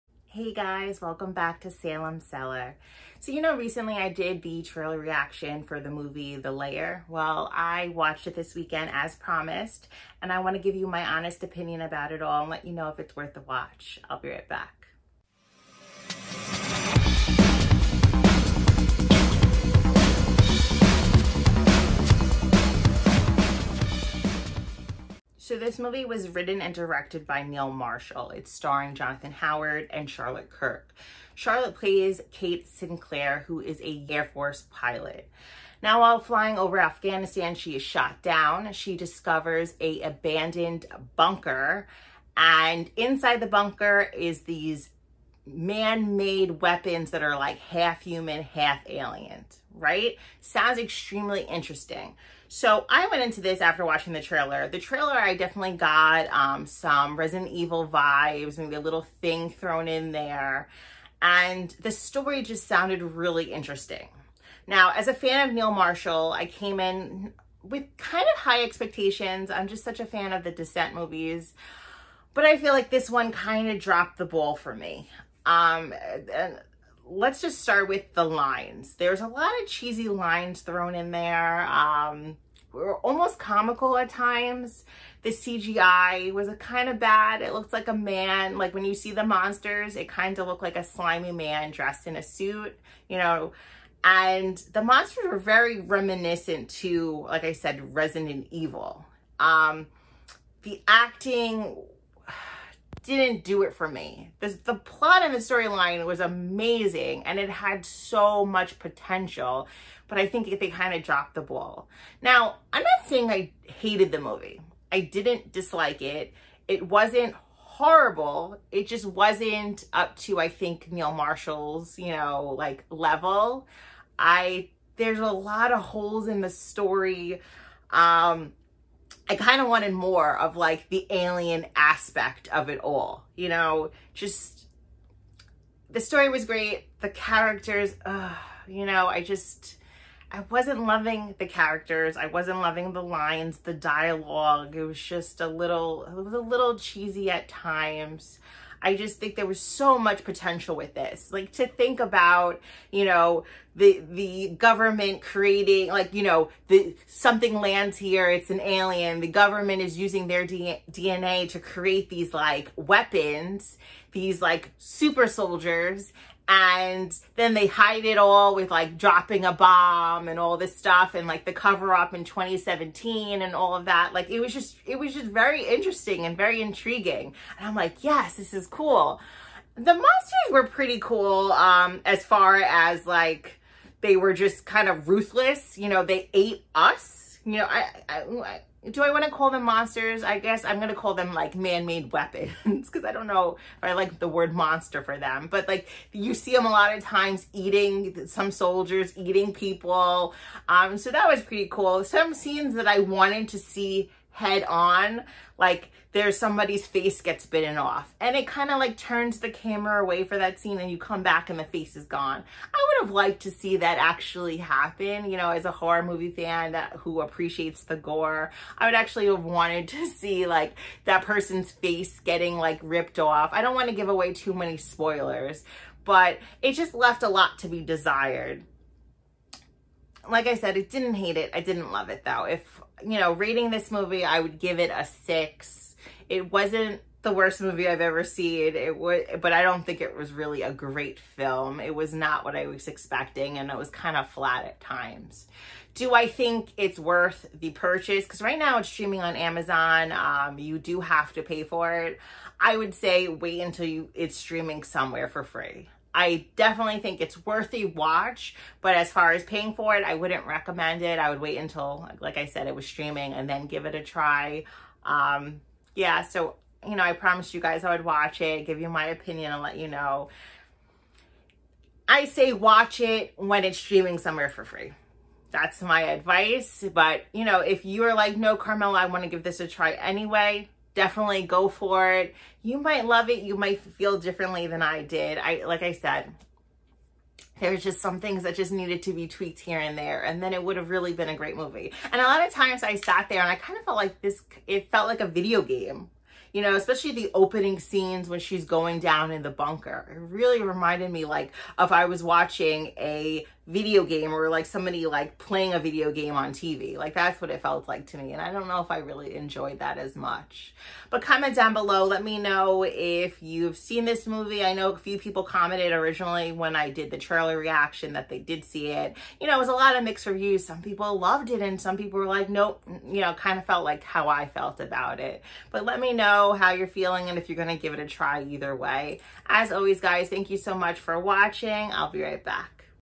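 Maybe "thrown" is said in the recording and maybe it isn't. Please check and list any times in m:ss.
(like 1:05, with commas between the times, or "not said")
0:59, 1:20.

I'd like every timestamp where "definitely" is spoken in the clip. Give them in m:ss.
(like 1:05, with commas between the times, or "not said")
0:55, 4:16, 4:40.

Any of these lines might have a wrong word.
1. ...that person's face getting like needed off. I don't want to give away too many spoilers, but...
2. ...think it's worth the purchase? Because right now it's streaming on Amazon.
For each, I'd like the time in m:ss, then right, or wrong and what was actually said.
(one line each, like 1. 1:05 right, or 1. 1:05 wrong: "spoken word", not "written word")
1. 3:41 wrong: "ripped", not "needed"
2. 4:06 right.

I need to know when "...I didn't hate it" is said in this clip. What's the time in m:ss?
3:50.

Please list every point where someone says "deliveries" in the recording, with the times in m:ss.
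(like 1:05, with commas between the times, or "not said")
not said.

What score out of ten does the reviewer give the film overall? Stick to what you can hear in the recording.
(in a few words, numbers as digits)
6.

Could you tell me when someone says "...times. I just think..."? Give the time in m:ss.
2:27.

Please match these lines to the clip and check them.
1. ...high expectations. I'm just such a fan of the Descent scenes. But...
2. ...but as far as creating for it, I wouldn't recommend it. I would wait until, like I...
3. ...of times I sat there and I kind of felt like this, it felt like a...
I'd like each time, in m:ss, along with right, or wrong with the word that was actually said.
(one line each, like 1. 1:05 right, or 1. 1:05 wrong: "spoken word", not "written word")
1. 1:08 wrong: "movies", not "scenes"
2. 4:18 wrong: "paying", not "creating"
3. 4:52 right.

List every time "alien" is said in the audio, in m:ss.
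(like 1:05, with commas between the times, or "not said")
0:48, 2:11, 2:38.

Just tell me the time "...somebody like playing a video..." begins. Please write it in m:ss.
5:04.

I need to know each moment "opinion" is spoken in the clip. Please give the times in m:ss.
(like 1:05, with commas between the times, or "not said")
0:11, 4:29.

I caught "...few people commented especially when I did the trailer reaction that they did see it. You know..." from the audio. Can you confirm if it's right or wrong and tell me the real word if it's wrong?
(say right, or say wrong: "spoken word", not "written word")
wrong: "originally", not "especially".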